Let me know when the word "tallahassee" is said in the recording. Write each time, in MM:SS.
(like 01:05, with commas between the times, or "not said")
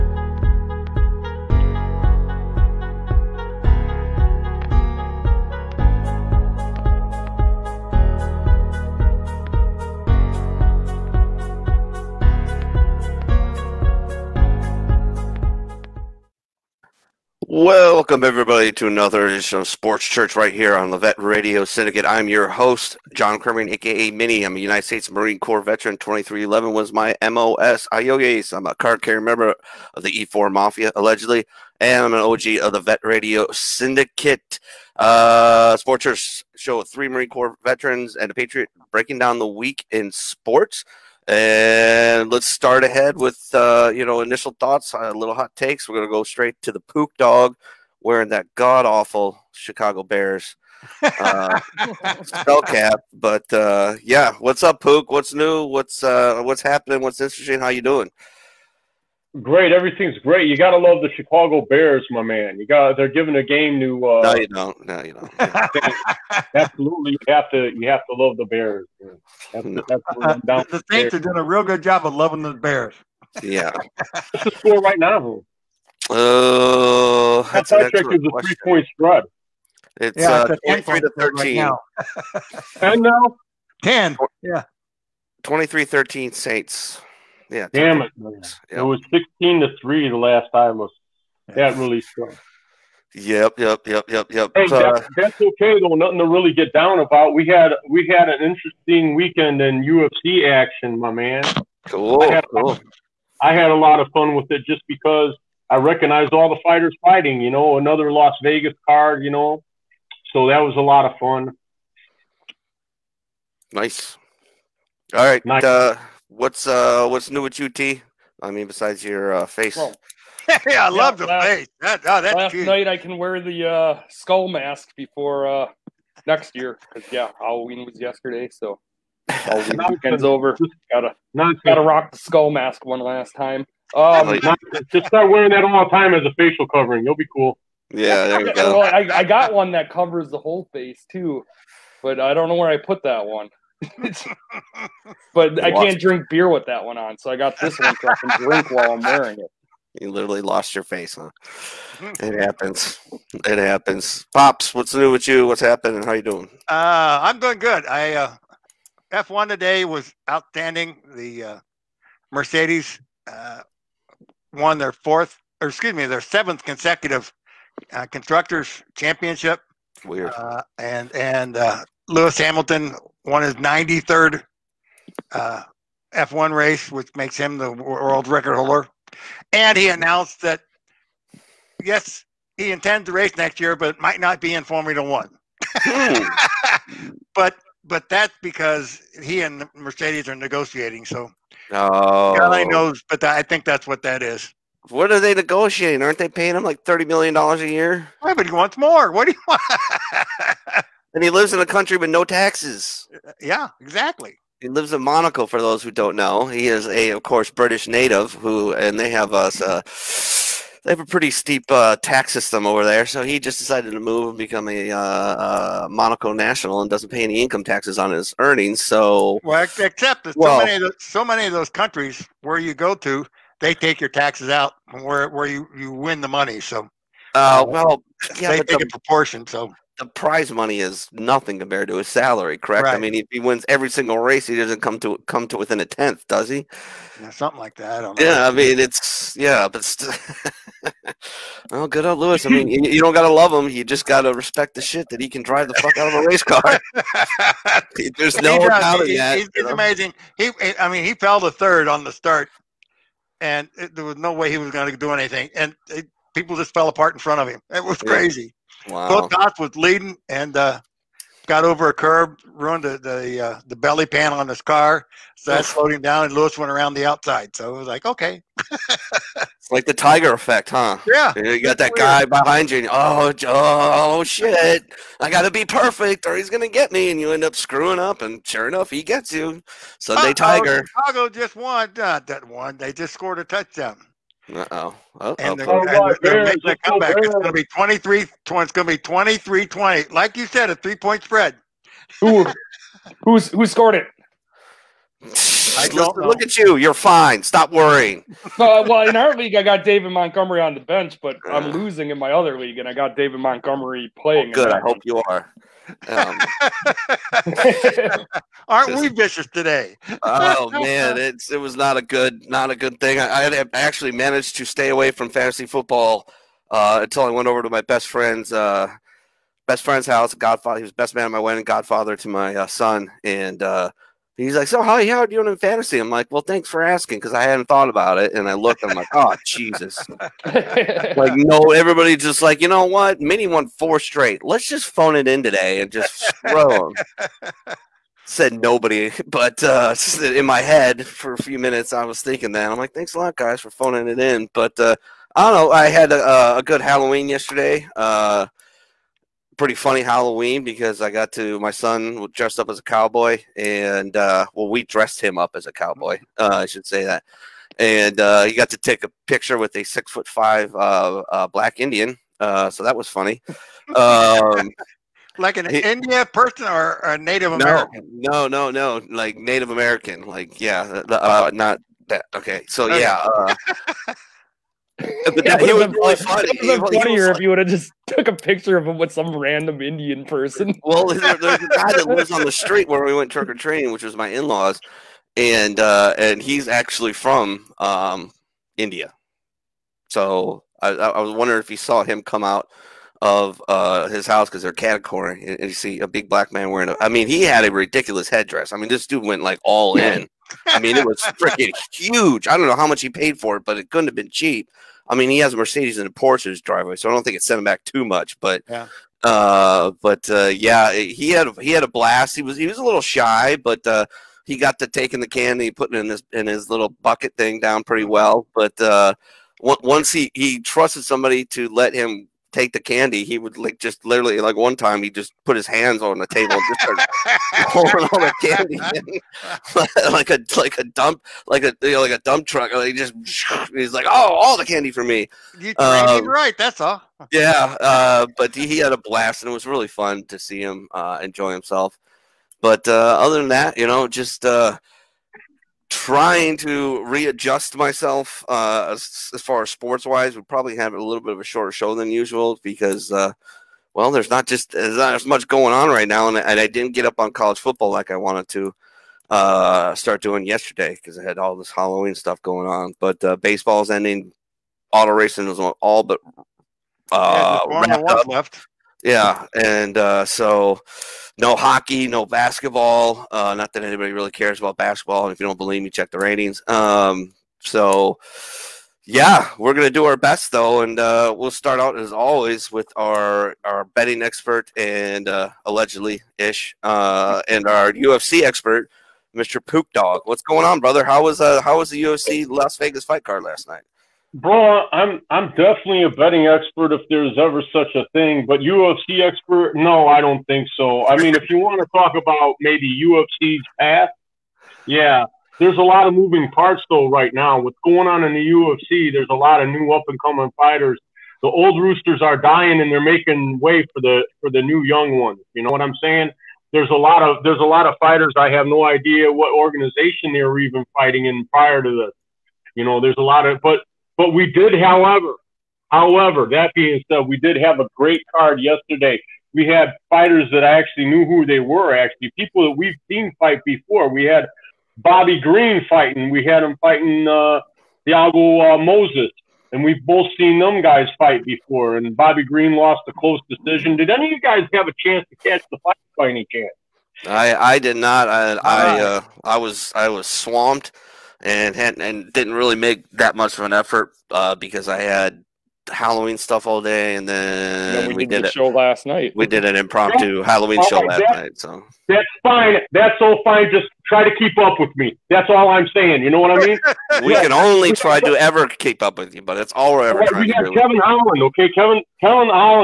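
not said.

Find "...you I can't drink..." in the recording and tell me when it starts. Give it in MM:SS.
02:25.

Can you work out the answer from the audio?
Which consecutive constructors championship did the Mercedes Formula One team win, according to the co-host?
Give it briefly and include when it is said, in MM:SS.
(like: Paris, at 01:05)
seventh, at 02:46.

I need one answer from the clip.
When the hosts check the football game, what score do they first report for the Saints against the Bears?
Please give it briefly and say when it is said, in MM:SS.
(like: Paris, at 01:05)
23 to 13, at 01:20.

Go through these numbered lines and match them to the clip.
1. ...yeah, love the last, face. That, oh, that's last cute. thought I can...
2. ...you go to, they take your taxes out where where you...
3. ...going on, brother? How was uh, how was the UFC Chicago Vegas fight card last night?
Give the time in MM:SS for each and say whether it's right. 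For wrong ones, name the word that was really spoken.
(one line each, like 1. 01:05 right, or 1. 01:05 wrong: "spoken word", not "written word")
1. 02:00 wrong: "night", not "thought"
2. 03:42 right
3. 08:10 wrong: "Las", not "Chicago".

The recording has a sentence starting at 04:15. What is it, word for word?
It, people just fell apart in front of him.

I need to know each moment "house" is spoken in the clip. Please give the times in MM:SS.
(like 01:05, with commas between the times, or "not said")
05:20, 06:34.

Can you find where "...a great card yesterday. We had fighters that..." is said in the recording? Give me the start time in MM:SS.
08:47.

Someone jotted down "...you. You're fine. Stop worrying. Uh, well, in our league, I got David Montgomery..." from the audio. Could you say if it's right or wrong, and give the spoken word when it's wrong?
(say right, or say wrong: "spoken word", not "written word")
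right.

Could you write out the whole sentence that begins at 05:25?
I'm like, well, thanks for asking because I hadn't thought about it.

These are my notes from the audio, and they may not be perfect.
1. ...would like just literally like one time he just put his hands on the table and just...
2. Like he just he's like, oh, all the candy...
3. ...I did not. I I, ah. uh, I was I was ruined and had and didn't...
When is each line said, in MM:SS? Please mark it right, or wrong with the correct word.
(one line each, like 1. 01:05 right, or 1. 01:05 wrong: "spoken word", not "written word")
1. 07:03 right
2. 07:12 right
3. 09:07 wrong: "swamped", not "ruined".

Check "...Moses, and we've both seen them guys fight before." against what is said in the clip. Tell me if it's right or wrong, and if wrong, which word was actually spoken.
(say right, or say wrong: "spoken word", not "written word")
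right.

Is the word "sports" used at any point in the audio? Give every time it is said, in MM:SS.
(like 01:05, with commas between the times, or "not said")
00:19, 00:35, 00:40, 07:29.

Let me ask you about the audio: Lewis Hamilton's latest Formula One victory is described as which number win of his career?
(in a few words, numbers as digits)
93rd.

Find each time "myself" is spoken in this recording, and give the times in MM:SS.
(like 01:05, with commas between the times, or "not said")
07:27.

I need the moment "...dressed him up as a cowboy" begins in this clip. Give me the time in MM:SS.
05:54.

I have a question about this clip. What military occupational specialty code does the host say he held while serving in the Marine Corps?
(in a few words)
2311.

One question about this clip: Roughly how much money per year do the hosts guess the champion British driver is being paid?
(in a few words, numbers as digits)
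$30 million.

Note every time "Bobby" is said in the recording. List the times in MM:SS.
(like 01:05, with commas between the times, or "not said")
08:54, 09:02.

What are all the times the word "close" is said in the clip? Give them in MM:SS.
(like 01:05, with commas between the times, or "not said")
09:03.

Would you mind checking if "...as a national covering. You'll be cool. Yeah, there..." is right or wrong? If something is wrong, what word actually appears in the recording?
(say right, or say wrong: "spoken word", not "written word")
wrong: "facial", not "national".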